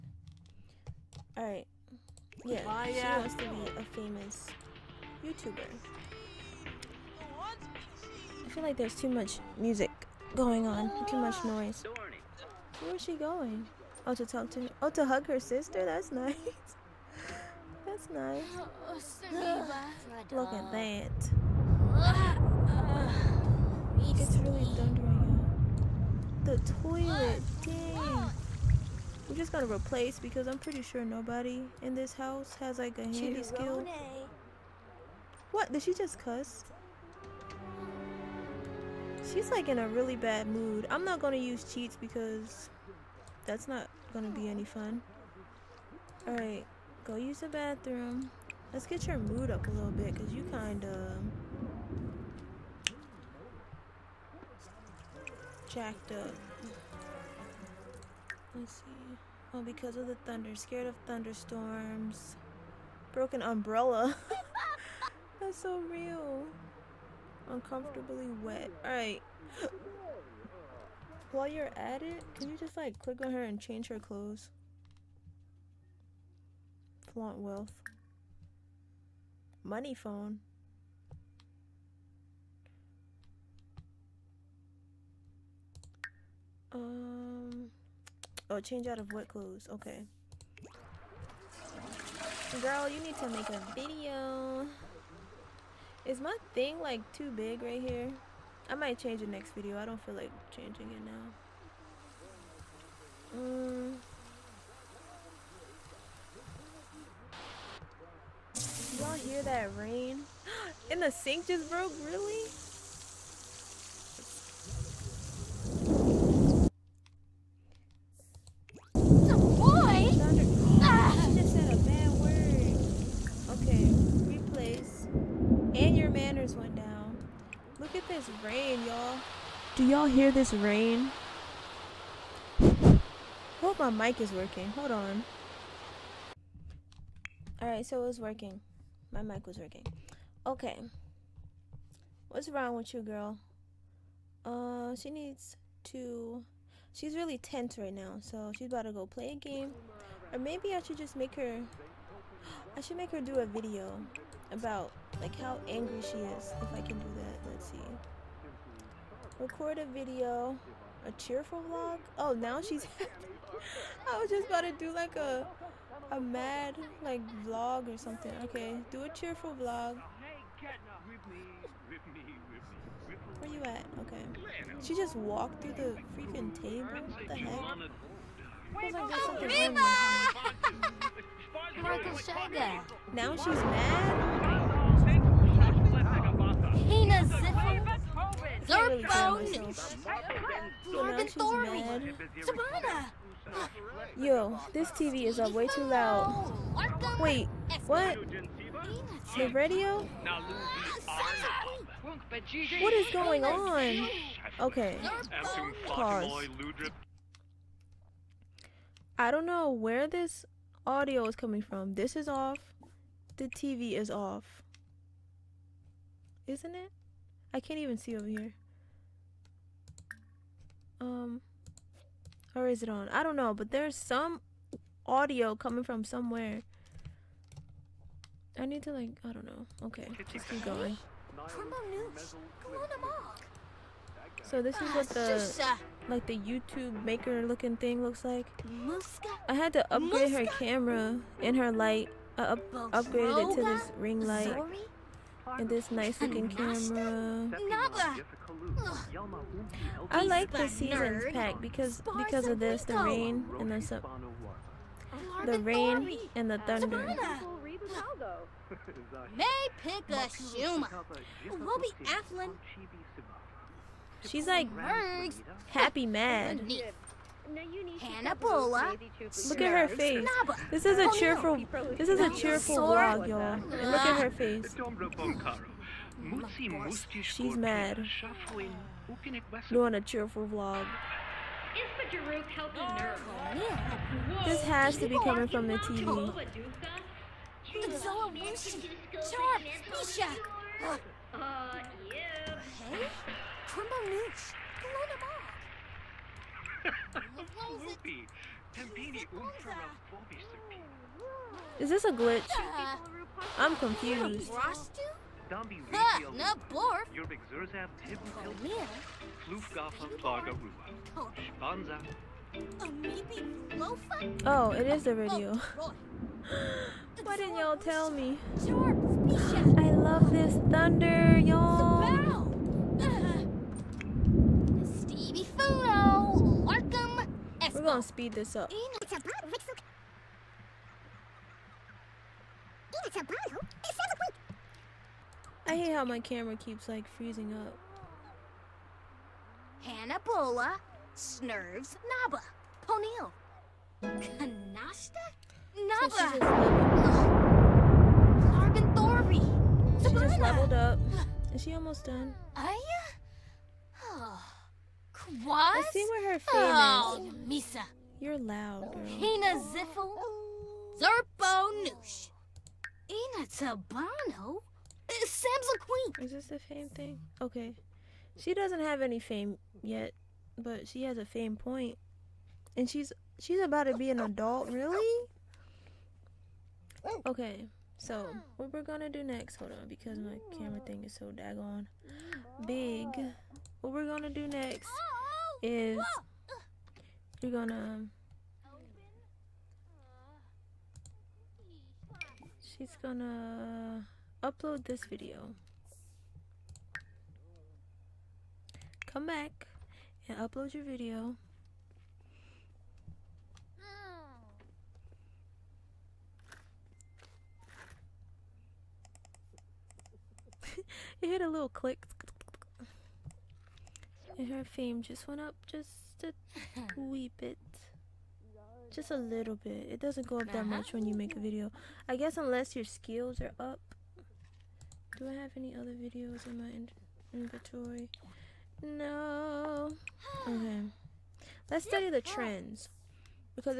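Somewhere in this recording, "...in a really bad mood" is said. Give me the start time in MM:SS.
00:39.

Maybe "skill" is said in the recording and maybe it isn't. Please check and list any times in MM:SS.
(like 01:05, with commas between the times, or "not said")
00:33, 07:02.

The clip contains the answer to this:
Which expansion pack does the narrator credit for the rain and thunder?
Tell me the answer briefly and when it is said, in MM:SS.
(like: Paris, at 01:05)
the seasons pack, at 04:10.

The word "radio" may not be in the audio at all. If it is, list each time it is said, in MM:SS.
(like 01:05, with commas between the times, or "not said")
03:19, 05:15.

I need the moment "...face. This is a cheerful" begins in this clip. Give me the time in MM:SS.
04:29.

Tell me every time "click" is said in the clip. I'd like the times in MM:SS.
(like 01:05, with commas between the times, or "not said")
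01:13, 06:51.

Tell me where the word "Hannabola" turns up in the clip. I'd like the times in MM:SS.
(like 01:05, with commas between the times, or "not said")
04:28.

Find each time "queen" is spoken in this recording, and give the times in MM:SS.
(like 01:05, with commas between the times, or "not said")
06:05.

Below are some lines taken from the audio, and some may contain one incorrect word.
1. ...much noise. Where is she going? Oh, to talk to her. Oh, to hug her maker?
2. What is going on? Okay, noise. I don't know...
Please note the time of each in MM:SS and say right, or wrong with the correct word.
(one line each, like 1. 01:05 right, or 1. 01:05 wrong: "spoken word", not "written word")
1. 00:11 wrong: "sister", not "maker"
2. 03:22 wrong: "pause", not "noise".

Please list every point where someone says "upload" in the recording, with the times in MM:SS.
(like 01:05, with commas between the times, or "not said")
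06:34, 06:40.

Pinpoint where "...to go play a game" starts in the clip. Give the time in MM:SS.
02:28.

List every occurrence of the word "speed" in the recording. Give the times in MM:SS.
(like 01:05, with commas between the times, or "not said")
05:28.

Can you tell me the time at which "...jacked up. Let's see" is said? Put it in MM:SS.
00:55.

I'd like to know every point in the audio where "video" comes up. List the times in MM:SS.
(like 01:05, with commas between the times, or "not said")
01:33, 01:39, 02:33, 02:39, 06:35, 06:40, 07:01, 07:05.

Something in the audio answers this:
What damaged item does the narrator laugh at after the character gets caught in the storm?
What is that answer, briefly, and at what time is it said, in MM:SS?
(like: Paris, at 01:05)
Broken umbrella, at 01:03.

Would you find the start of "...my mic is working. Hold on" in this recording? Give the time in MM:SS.
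02:13.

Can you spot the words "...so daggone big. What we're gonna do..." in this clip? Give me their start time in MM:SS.
06:21.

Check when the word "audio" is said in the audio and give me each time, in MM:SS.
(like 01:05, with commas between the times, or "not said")
03:30, 03:45.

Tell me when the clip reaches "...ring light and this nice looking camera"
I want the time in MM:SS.
04:03.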